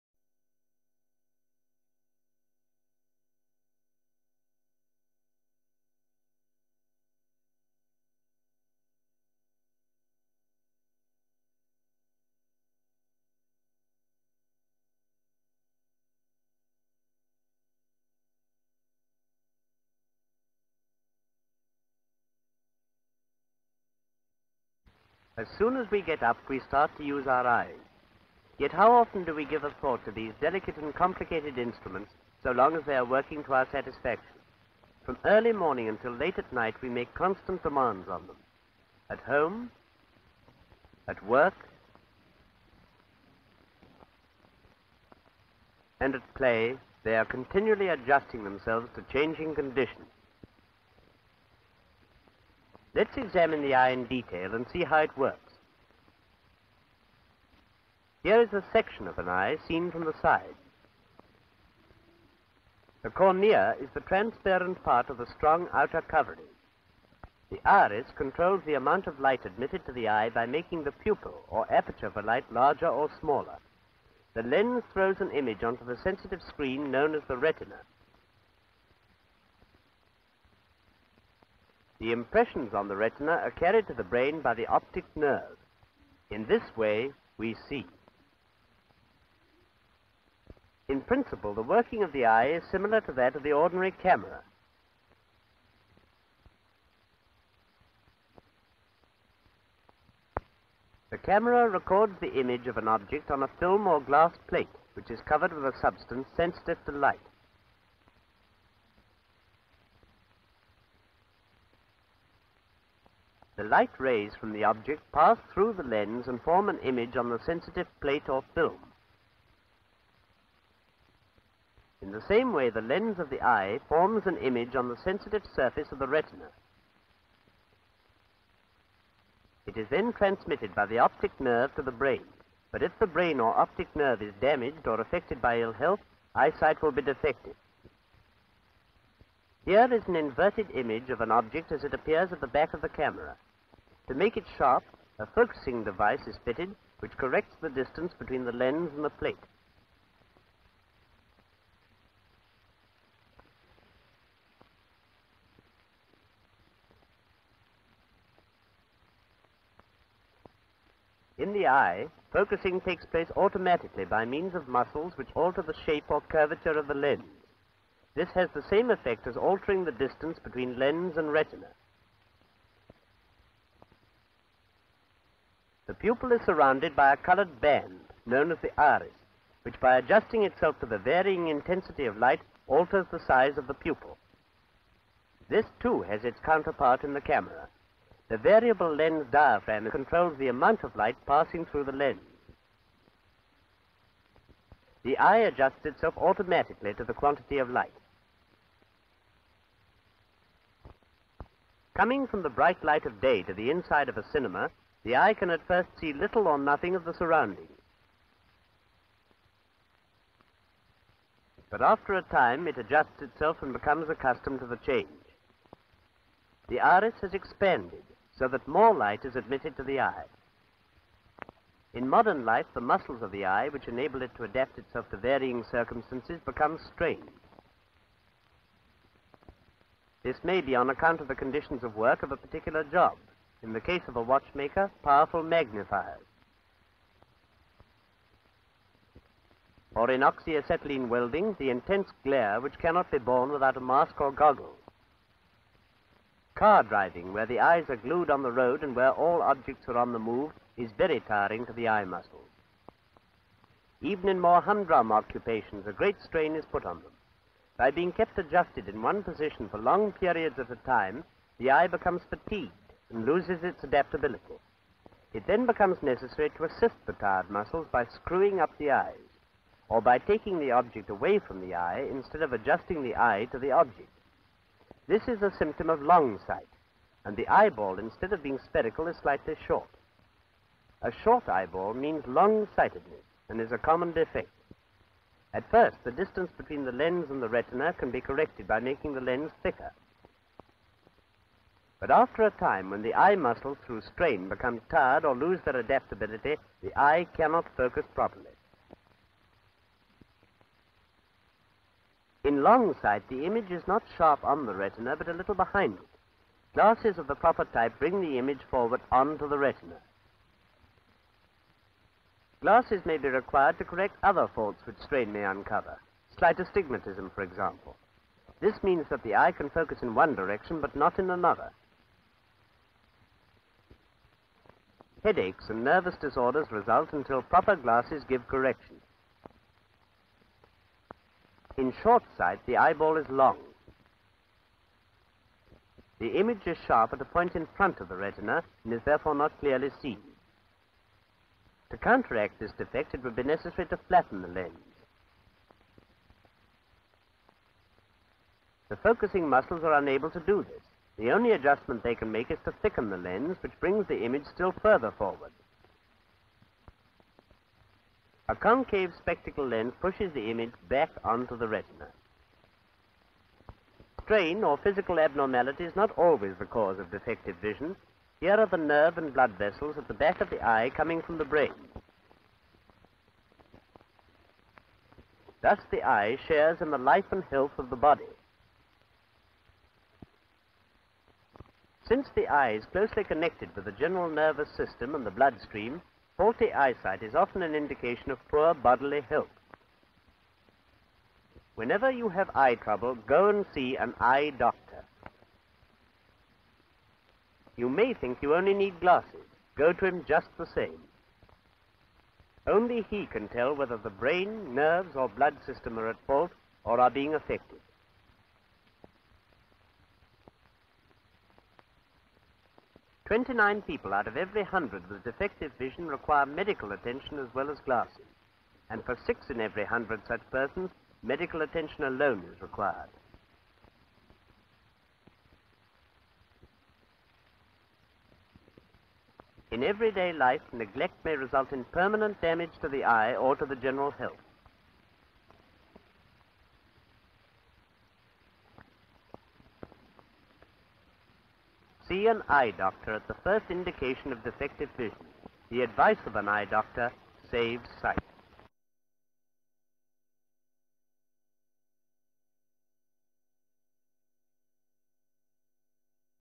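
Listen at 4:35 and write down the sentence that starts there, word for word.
This is a symptom of long sight, and the eyeball, instead of being spherical, is slightly short.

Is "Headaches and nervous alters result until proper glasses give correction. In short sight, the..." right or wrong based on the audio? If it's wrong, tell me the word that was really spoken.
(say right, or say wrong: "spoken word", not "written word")
wrong: "disorders", not "alters".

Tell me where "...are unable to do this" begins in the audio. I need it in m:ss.
5:49.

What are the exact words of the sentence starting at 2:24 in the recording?
To make it sharp, a focusing device is fitted which corrects the distance between the lens and the plate.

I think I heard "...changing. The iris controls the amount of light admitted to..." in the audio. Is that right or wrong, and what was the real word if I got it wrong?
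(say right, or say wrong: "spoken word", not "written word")
wrong: "covering", not "changing".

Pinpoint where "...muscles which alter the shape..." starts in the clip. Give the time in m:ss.
2:44.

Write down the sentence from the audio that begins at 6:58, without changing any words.
And for six in every hundred such persons, medical attention alone is required.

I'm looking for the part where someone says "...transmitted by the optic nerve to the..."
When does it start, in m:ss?
2:10.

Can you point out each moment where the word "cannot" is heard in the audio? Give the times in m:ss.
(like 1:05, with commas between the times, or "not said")
4:02, 4:57.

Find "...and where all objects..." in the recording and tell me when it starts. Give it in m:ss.
4:08.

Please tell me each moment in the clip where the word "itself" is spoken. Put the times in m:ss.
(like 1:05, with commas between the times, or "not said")
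3:00, 3:15, 3:33, 3:44.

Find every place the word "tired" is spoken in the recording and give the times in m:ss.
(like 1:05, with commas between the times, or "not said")
4:27, 4:54.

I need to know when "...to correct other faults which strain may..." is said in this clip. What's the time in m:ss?
5:13.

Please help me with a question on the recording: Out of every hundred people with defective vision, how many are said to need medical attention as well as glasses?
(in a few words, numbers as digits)
29.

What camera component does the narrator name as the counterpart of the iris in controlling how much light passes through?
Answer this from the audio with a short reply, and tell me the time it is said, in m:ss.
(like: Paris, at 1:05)
variable lens diaphragm, at 3:08.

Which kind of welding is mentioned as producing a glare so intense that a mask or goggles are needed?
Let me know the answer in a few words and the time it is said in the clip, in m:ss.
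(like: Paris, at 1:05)
oxyacetylene welding, at 4:00.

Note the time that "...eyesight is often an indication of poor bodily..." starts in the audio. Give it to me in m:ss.
6:26.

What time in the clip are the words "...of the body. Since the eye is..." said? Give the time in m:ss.
6:17.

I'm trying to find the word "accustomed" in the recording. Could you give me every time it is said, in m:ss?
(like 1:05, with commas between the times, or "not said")
3:34.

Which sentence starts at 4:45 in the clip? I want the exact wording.
At first, the distance between the lens and the retina can be corrected by making the lens thicker.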